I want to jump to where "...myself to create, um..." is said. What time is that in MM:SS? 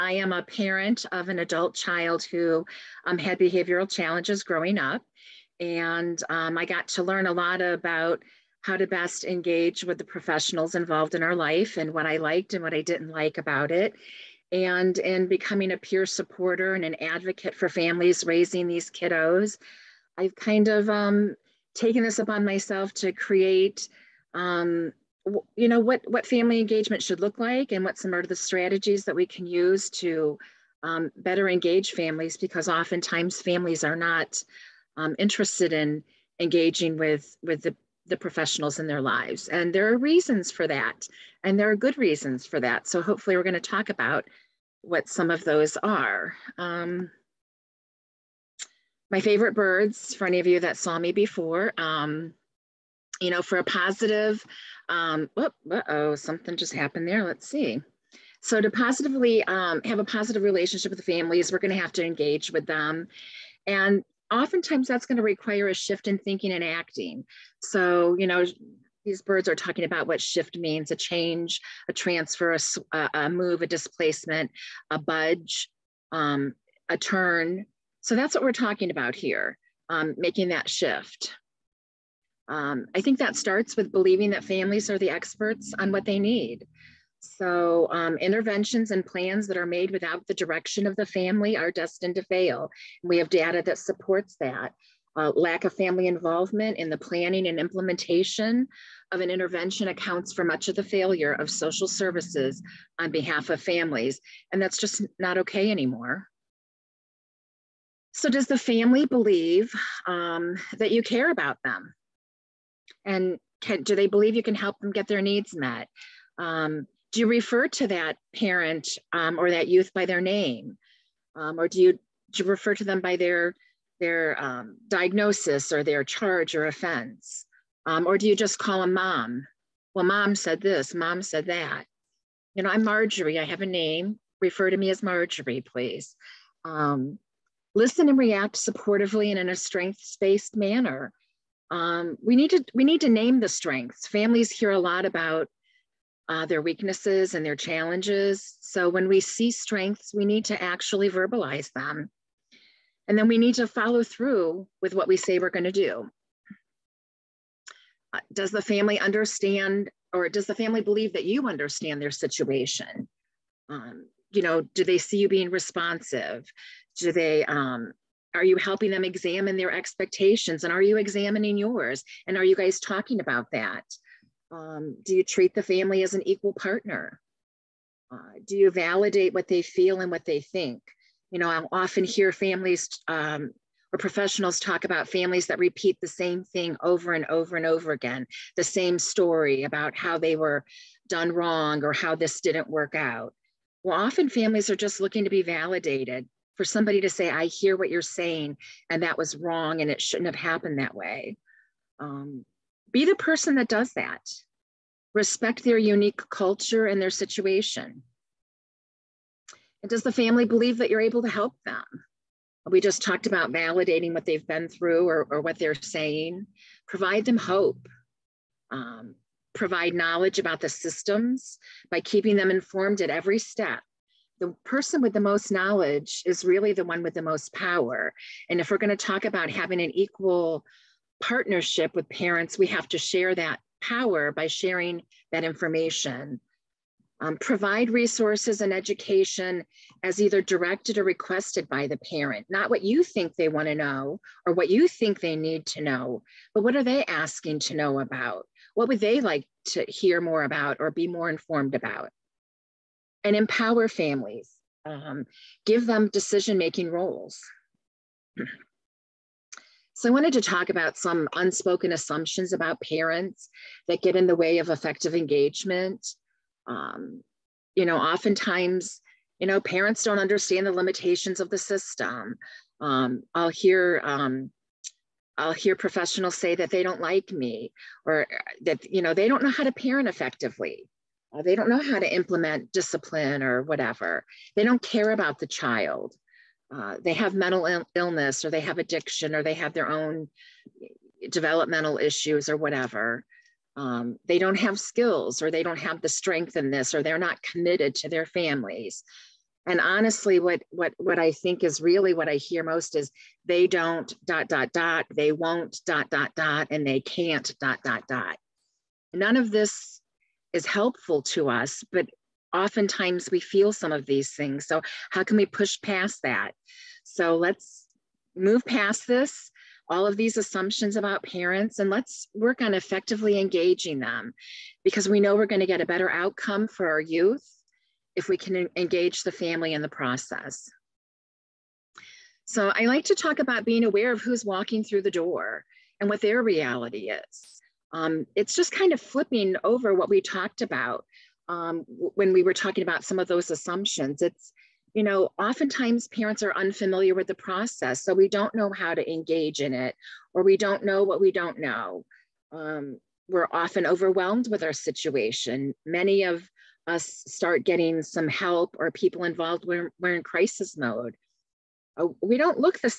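00:22.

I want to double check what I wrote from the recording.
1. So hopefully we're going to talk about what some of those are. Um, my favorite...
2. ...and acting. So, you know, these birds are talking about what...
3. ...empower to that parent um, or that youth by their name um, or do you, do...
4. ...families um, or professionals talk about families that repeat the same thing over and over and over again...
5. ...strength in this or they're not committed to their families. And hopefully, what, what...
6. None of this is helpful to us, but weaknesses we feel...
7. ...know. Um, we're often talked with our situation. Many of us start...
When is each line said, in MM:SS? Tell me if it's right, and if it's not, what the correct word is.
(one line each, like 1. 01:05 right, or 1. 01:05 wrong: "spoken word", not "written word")
1. 00:42 right
2. 01:06 right
3. 01:57 wrong: "refer", not "empower"
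4. 03:02 right
5. 04:56 wrong: "honestly", not "hopefully"
6. 05:09 wrong: "oftentimes", not "weaknesses"
7. 05:51 wrong: "overwhelmed", not "talked".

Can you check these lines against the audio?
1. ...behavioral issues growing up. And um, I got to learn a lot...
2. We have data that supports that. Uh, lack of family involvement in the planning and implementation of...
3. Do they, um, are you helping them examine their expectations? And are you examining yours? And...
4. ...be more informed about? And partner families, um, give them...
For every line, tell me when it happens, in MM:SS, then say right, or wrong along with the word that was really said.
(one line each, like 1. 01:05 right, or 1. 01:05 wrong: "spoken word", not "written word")
1. 00:03 wrong: "challenges", not "issues"
2. 01:33 right
3. 02:46 right
4. 04:10 wrong: "empower", not "partner".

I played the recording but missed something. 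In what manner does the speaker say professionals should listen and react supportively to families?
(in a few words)
Strengths-based.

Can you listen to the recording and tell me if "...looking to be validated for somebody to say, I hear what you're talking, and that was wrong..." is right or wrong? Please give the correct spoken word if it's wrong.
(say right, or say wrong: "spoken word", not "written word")
wrong: "saying", not "talking".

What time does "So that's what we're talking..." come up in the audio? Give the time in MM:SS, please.
01:18.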